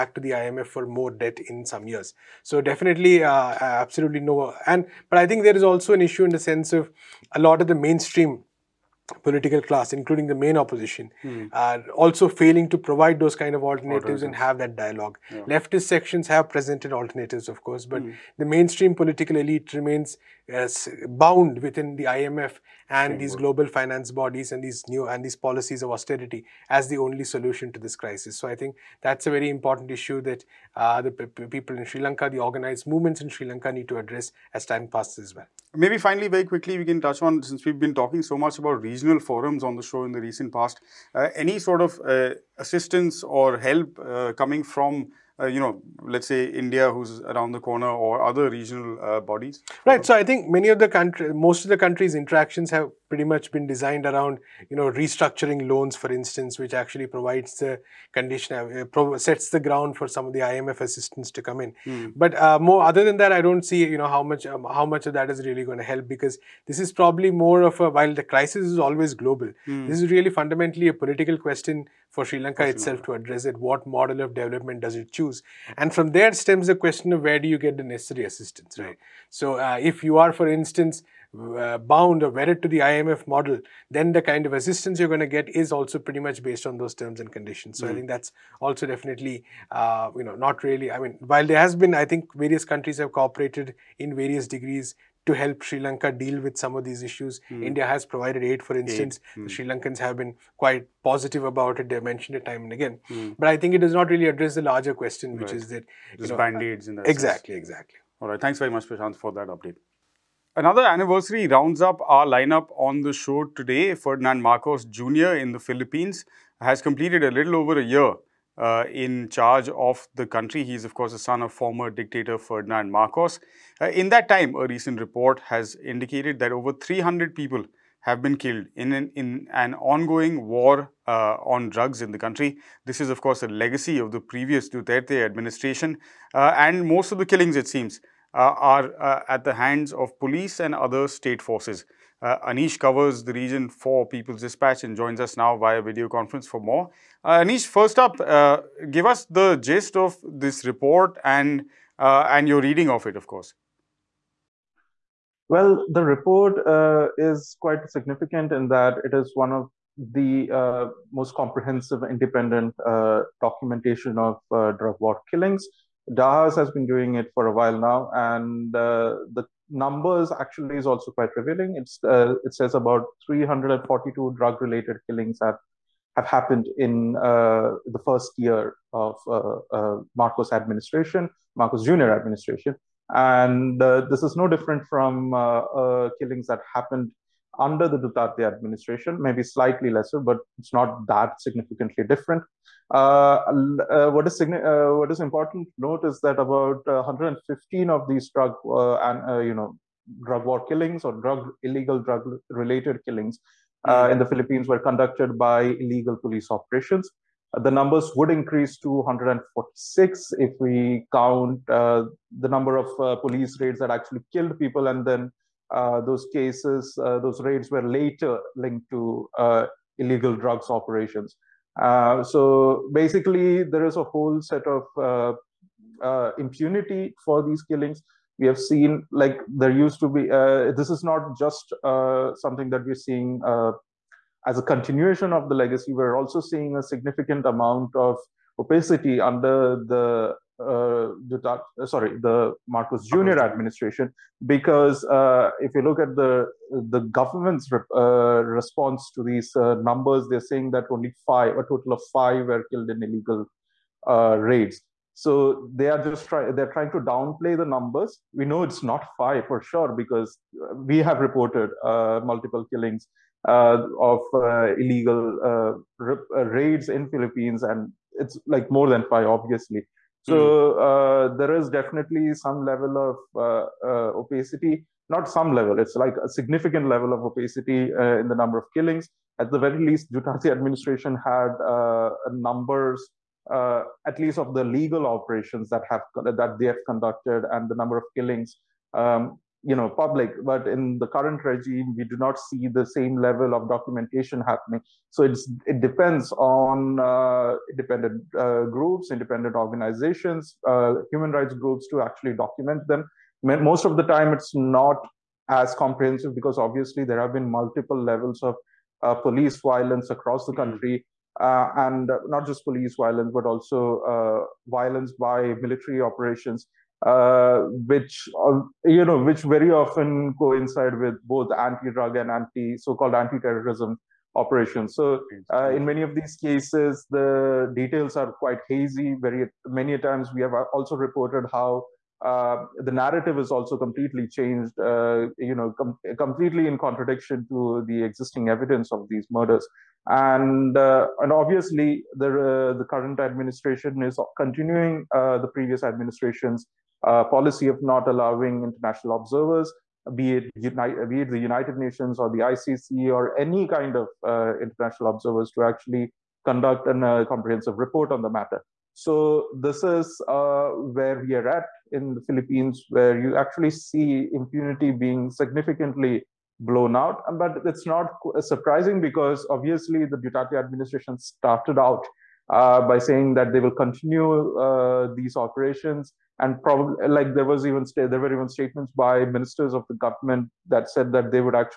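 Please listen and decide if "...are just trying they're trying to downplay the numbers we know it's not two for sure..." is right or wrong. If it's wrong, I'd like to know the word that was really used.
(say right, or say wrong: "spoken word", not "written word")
wrong: "five", not "two".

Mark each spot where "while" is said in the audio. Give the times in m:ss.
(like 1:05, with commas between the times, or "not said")
1:07, 1:31, 2:47.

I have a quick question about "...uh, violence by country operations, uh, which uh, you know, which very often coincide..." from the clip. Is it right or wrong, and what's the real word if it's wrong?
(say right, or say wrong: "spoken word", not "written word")
wrong: "military", not "country".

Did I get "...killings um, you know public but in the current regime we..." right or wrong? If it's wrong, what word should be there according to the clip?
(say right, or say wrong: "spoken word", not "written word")
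right.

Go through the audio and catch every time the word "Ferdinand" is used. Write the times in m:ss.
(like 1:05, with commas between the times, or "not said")
1:53, 2:02.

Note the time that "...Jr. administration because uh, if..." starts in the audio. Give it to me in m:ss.
4:03.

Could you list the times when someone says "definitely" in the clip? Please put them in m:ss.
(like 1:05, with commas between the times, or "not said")
0:02, 1:28, 4:31.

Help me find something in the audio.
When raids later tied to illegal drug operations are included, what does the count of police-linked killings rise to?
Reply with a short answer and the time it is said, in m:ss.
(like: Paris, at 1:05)
146, at 3:28.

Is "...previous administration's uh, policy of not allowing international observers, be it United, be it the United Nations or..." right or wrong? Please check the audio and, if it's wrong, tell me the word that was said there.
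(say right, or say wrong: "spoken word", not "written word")
right.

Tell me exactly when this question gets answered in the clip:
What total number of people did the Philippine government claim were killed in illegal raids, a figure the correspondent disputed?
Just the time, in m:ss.
4:11.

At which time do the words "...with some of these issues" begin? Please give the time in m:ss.
1:36.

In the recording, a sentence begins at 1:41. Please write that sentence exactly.
They've mentioned it time and again.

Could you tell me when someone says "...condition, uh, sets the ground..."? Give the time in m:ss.
0:58.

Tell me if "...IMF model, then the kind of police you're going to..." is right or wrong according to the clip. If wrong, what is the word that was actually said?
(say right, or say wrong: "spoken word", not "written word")
wrong: "assistance", not "police".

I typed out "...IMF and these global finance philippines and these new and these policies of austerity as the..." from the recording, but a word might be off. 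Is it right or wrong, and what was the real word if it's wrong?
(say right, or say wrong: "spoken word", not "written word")
wrong: "bodies", not "philippines".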